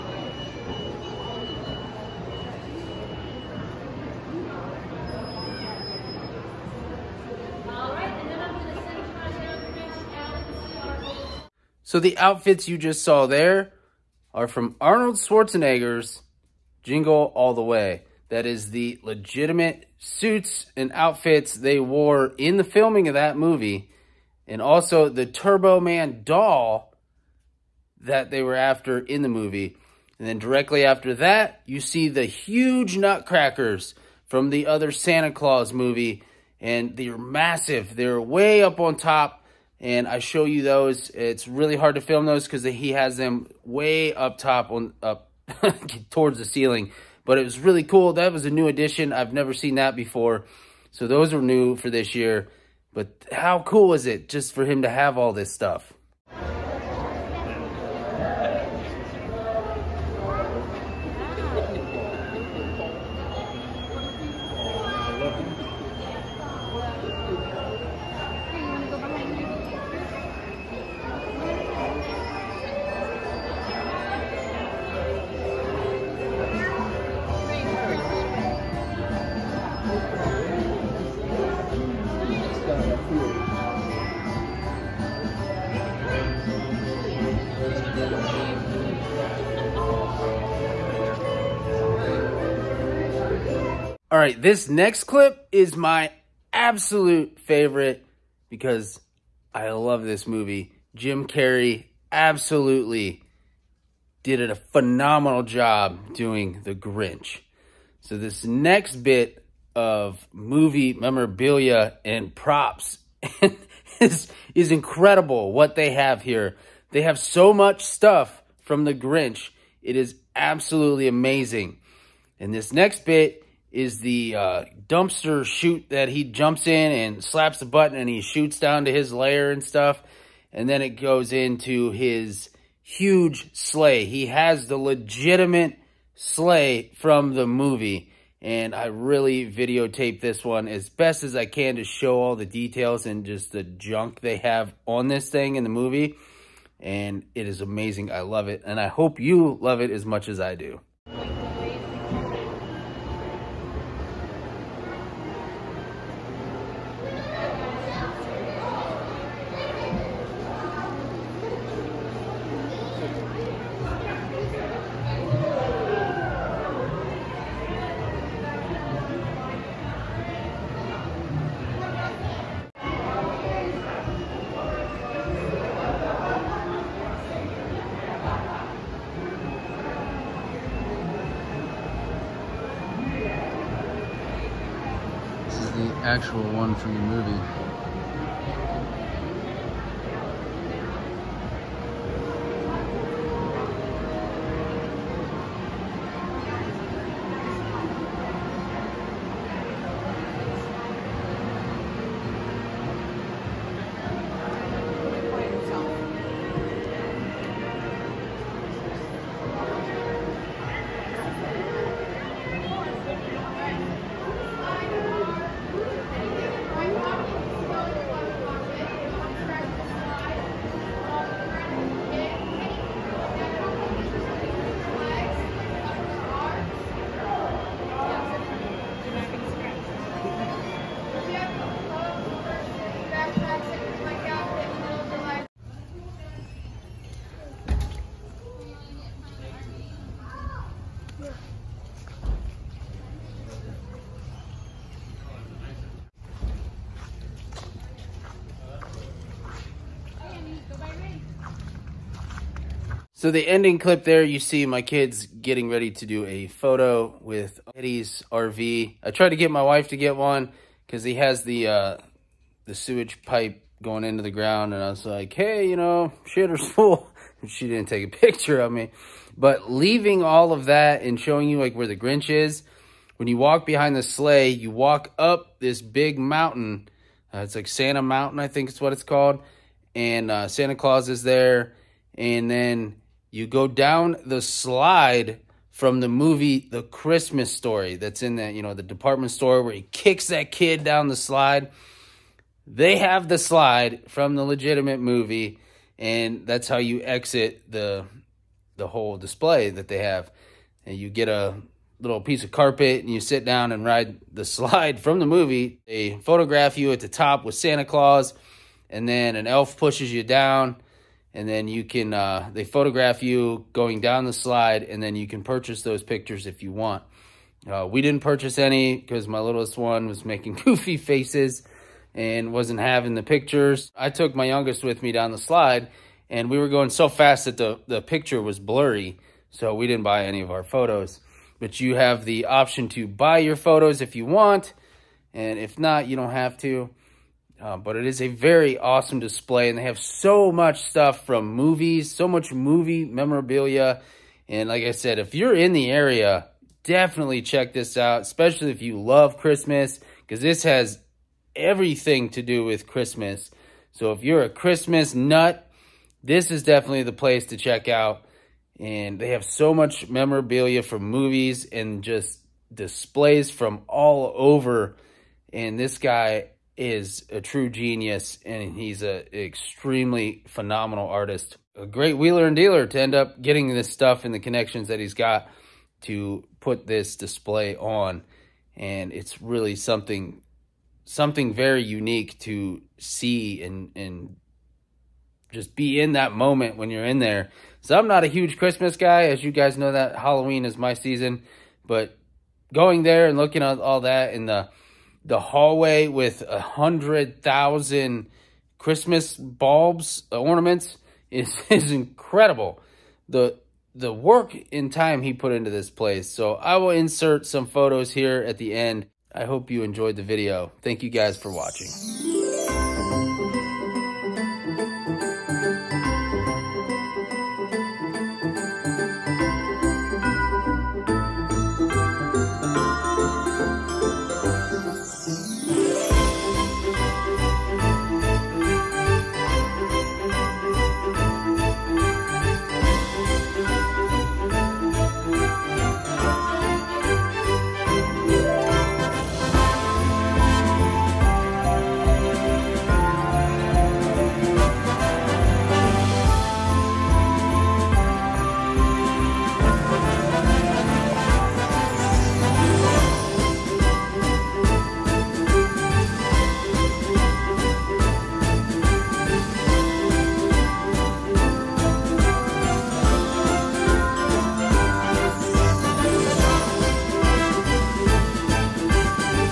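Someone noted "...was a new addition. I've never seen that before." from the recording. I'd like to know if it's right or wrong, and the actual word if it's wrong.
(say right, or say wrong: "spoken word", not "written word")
right.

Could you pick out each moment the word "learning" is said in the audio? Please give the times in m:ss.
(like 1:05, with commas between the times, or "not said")
not said.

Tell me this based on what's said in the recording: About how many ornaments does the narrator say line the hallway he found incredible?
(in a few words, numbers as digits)
100,000.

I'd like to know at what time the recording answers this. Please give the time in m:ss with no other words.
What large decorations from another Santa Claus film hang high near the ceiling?
0:32.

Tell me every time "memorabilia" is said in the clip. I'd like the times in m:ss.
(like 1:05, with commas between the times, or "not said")
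1:50, 5:43, 6:00.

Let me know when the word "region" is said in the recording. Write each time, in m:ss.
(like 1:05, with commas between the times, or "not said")
not said.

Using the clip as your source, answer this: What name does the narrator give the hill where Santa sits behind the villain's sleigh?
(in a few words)
Santa Mountain.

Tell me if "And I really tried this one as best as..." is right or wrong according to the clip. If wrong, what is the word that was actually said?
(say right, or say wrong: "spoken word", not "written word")
wrong: "videotaped", not "tried".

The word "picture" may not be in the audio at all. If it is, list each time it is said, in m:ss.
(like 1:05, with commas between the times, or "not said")
4:28, 5:16, 5:23, 5:28.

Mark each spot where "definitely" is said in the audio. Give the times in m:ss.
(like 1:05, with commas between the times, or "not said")
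5:46, 5:56.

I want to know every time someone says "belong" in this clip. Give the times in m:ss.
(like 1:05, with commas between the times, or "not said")
not said.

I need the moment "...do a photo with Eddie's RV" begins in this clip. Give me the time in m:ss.
4:16.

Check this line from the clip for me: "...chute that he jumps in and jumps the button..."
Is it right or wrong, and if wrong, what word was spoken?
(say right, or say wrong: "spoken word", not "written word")
wrong: "slaps", not "jumps".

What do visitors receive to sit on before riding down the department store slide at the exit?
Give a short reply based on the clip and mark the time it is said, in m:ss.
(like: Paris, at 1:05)
piece of carpet, at 5:02.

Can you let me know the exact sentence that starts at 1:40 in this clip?
Jim Carrey absolutely did a phenomenal job doing The Grinch.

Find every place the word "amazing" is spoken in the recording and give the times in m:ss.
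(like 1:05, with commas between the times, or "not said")
2:01, 2:27.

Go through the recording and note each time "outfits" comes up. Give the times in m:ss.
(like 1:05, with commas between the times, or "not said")
0:12, 0:20.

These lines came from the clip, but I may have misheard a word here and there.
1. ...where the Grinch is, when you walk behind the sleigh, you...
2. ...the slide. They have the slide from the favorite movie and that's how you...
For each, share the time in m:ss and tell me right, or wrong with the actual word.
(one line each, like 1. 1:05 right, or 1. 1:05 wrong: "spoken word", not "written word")
1. 4:31 right
2. 4:51 wrong: "legitimate", not "favorite".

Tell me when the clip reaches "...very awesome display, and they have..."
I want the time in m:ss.
5:38.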